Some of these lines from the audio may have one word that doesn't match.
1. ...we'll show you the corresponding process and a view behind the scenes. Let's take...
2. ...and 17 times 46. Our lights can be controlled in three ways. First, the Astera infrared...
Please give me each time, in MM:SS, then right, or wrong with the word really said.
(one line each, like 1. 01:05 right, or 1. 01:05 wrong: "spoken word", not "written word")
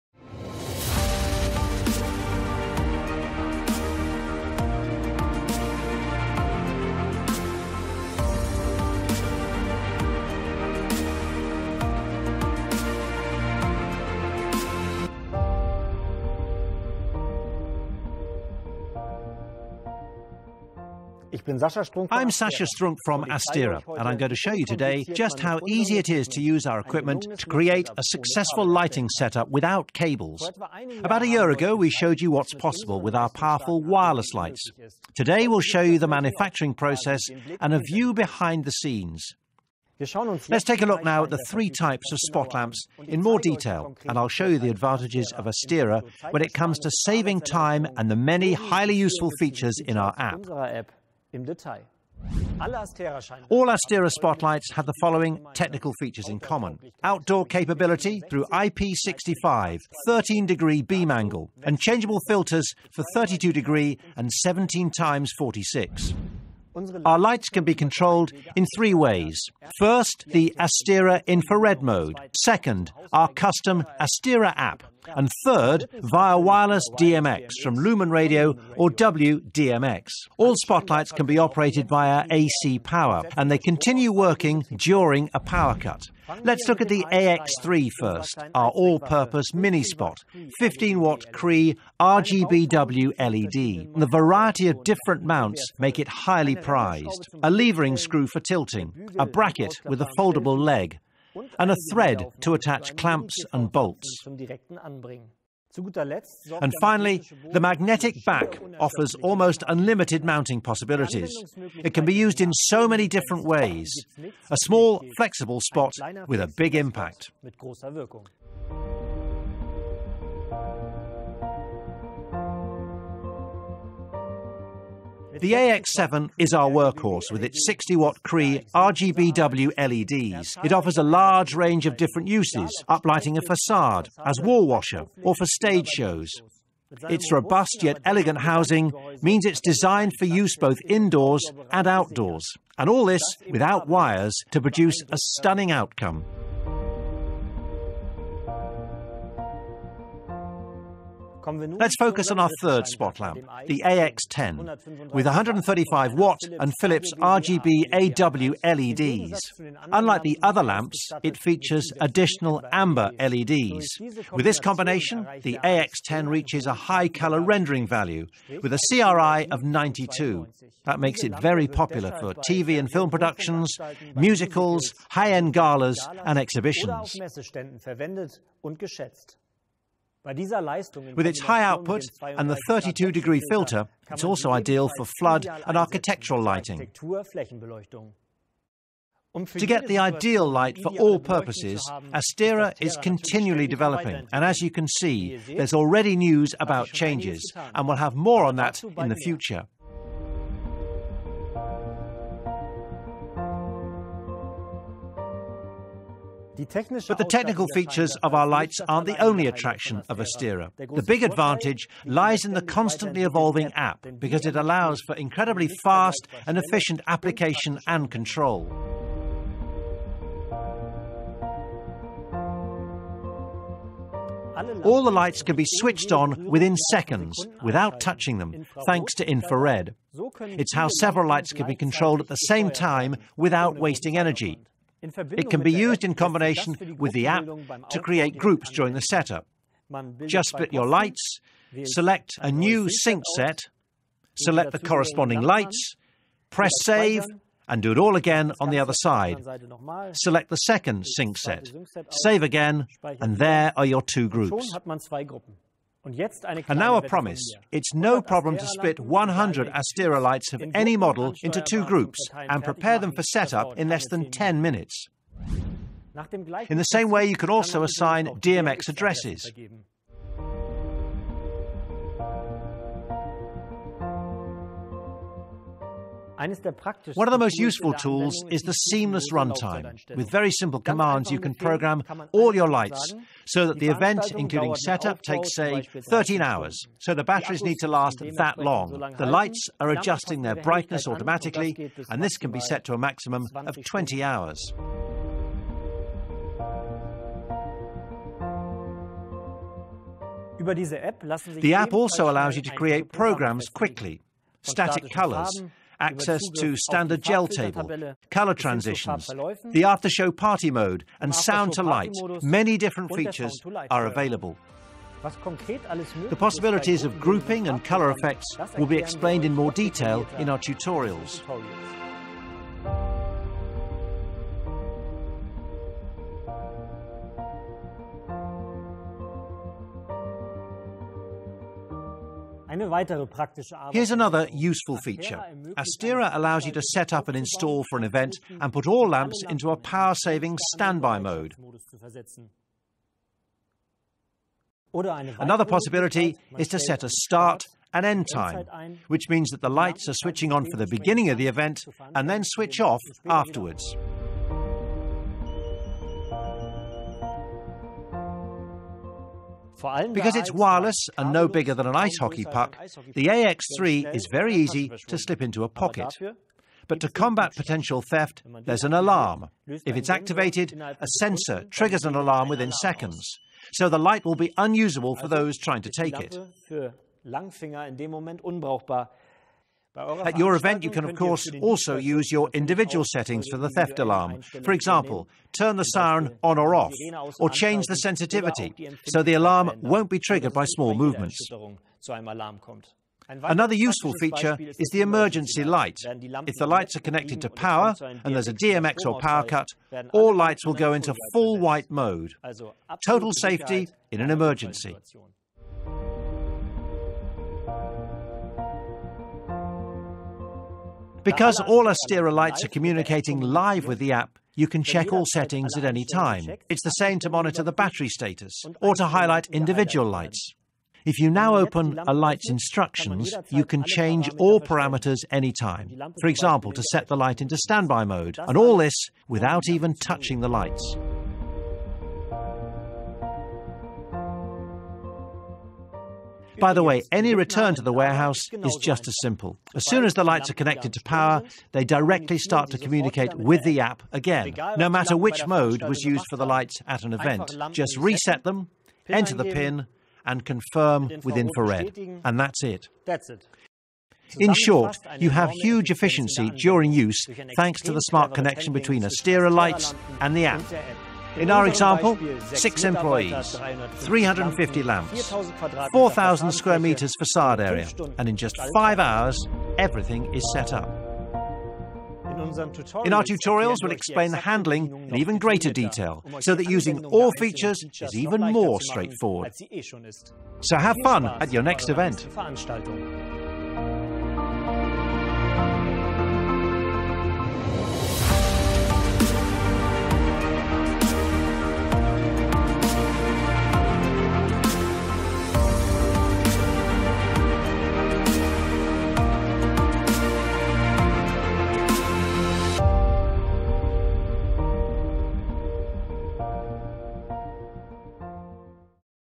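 1. 00:35 wrong: "manufacturing", not "corresponding"
2. 01:04 right.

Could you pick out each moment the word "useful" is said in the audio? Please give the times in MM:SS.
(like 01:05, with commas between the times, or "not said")
00:48, 04:37, 05:34, 06:33.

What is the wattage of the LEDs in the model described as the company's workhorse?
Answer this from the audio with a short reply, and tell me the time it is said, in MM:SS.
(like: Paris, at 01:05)
60 watt, at 02:07.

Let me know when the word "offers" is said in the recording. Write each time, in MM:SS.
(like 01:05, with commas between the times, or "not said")
01:48, 02:10.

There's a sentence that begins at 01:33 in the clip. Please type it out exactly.
The variety of different mounts make it highly prized.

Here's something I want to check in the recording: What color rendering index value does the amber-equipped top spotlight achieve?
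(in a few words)
92.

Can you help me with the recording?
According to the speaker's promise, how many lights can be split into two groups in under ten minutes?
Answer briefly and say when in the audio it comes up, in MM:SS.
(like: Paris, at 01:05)
100, at 04:18.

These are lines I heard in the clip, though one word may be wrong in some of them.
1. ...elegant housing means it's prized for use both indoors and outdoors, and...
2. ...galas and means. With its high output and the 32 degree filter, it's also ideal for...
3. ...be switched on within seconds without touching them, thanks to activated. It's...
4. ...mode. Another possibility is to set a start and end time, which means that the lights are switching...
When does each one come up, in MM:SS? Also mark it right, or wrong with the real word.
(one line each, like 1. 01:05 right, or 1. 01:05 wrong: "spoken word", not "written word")
1. 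02:18 wrong: "designed", not "prized"
2. 02:55 wrong: "exhibitions", not "means"
3. 03:45 wrong: "infrared", not "activated"
4. 05:41 right.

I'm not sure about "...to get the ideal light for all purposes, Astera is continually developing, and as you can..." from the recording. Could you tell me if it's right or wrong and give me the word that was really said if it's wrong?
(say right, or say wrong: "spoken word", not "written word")
right.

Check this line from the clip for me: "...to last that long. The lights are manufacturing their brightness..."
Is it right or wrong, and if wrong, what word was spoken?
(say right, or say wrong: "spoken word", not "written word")
wrong: "adjusting", not "manufacturing".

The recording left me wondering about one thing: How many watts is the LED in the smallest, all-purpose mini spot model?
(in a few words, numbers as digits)
15 watt.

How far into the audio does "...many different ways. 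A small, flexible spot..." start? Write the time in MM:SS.
01:52.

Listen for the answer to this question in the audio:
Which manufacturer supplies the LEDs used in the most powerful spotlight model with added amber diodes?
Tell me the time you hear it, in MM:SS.
02:36.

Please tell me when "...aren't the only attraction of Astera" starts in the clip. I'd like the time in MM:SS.
03:28.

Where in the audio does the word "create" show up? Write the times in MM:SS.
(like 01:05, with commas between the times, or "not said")
00:27, 03:57, 05:02.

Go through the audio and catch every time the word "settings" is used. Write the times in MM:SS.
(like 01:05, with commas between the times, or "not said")
06:23, 06:55.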